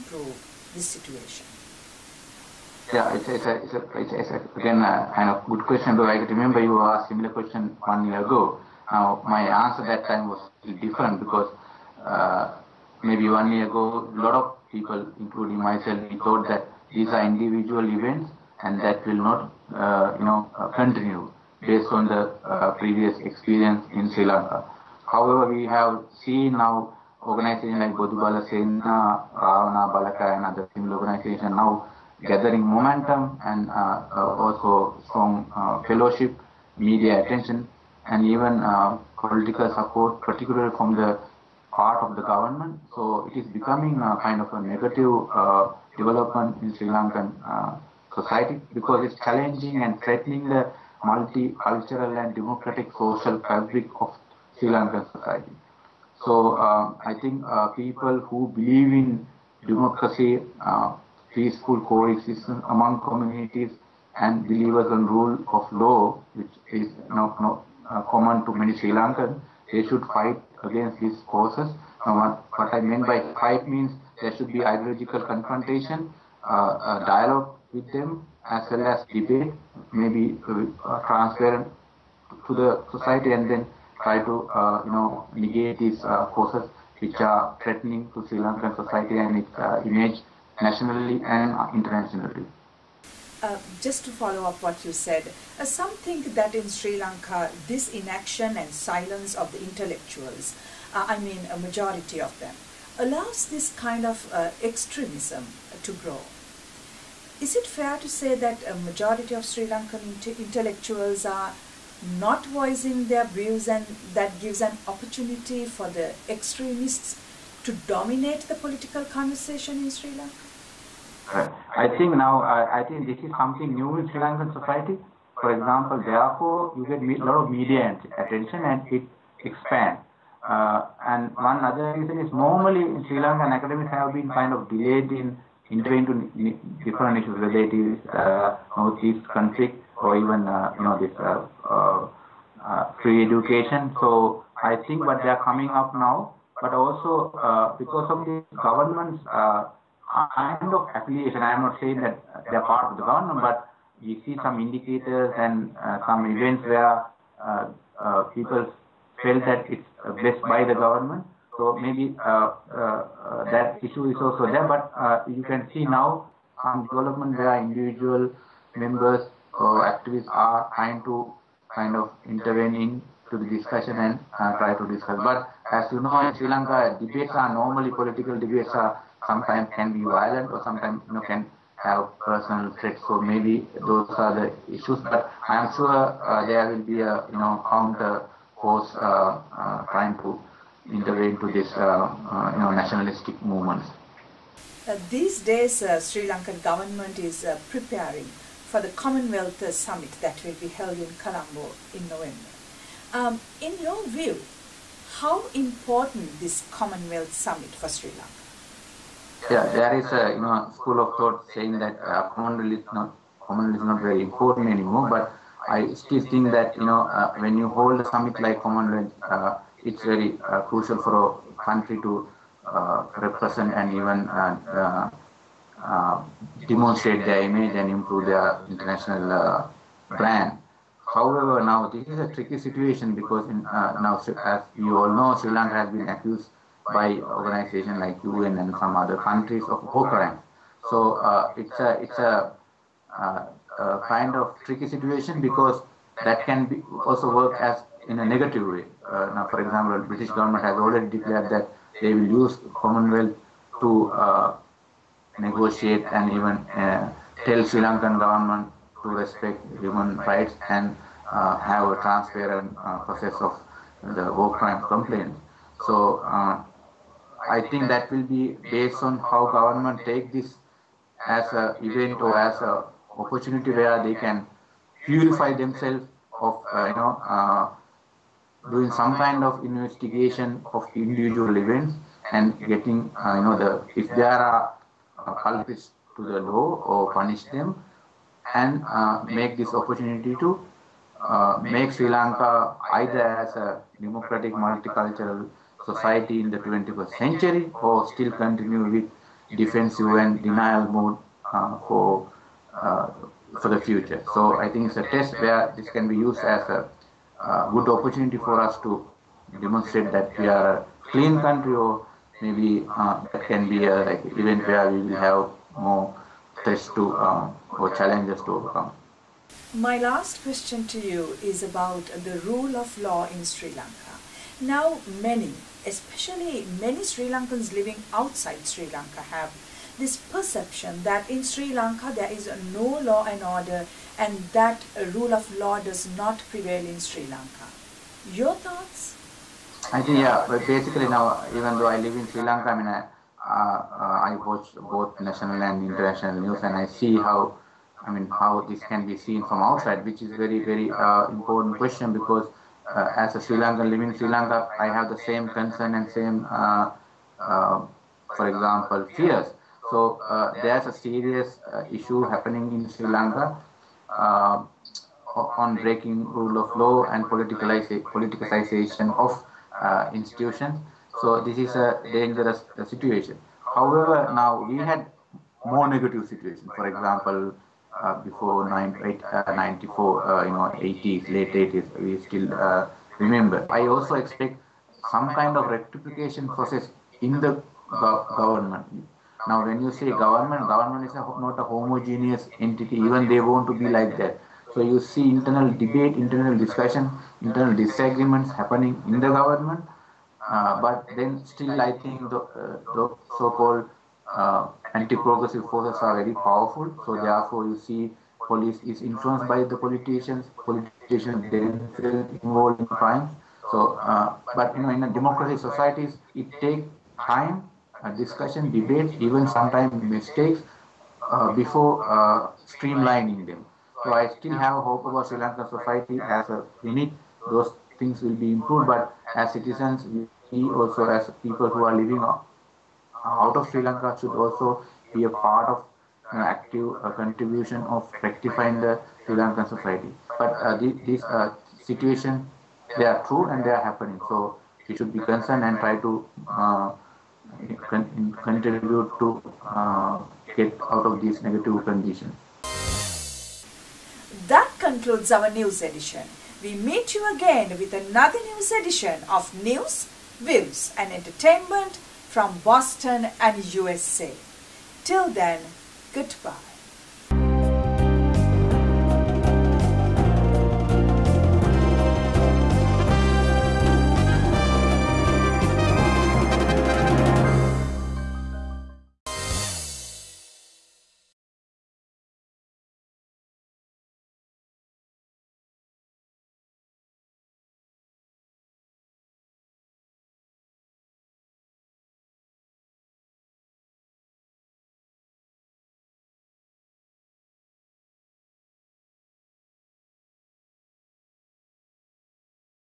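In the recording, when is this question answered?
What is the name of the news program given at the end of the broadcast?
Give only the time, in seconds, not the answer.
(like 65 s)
459 s.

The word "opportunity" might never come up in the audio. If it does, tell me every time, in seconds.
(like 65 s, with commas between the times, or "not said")
114 s, 273 s, 289 s, 307 s.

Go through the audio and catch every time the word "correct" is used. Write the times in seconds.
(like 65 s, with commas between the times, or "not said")
not said.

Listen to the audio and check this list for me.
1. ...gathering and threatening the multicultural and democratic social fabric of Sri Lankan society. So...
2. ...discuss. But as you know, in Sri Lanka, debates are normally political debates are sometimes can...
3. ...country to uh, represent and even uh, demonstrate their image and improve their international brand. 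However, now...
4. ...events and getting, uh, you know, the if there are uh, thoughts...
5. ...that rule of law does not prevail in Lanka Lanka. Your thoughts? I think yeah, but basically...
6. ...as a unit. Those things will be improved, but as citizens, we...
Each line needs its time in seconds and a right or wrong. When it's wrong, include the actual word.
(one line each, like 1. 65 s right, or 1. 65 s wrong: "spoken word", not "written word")
1. 49 s wrong: "challenging", not "gathering"
2. 174 s right
3. 221 s right
4. 281 s wrong: "culprits", not "thoughts"
5. 334 s wrong: "Sri", not "Lanka"
6. 426 s right.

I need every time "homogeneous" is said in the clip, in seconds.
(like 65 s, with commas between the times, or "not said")
391 s.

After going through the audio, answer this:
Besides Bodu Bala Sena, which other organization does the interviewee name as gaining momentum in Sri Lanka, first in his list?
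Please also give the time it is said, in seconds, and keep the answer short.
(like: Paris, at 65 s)
Ravana Balaka, at 29 s.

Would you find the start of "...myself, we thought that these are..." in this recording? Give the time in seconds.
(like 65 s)
15 s.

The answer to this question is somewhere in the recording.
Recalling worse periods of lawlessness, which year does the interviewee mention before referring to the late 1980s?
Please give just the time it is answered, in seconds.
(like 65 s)
379 s.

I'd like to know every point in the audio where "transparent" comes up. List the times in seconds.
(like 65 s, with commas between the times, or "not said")
81 s, 262 s.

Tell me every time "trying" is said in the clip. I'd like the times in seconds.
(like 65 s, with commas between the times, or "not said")
170 s, 189 s.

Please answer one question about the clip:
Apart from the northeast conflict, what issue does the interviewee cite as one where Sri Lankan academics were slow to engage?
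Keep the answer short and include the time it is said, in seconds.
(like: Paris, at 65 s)
free education, at 143 s.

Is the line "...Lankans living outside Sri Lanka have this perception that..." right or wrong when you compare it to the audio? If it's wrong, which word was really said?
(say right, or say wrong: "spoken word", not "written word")
right.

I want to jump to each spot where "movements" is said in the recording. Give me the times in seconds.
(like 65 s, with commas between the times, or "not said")
193 s.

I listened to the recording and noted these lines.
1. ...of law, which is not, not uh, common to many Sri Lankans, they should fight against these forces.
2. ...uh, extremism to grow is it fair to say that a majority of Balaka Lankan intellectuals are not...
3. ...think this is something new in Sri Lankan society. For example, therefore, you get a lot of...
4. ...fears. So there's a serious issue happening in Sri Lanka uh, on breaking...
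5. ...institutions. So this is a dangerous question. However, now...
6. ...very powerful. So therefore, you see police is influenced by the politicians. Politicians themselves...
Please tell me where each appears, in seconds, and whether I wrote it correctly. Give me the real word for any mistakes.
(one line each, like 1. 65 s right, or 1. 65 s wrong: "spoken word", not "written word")
1. 65 s right
2. 104 s wrong: "Sri", not "Balaka"
3. 122 s right
4. 359 s right
5. 370 s wrong: "situation", not "question"
6. 406 s right.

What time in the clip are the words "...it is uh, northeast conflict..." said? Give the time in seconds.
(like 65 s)
137 s.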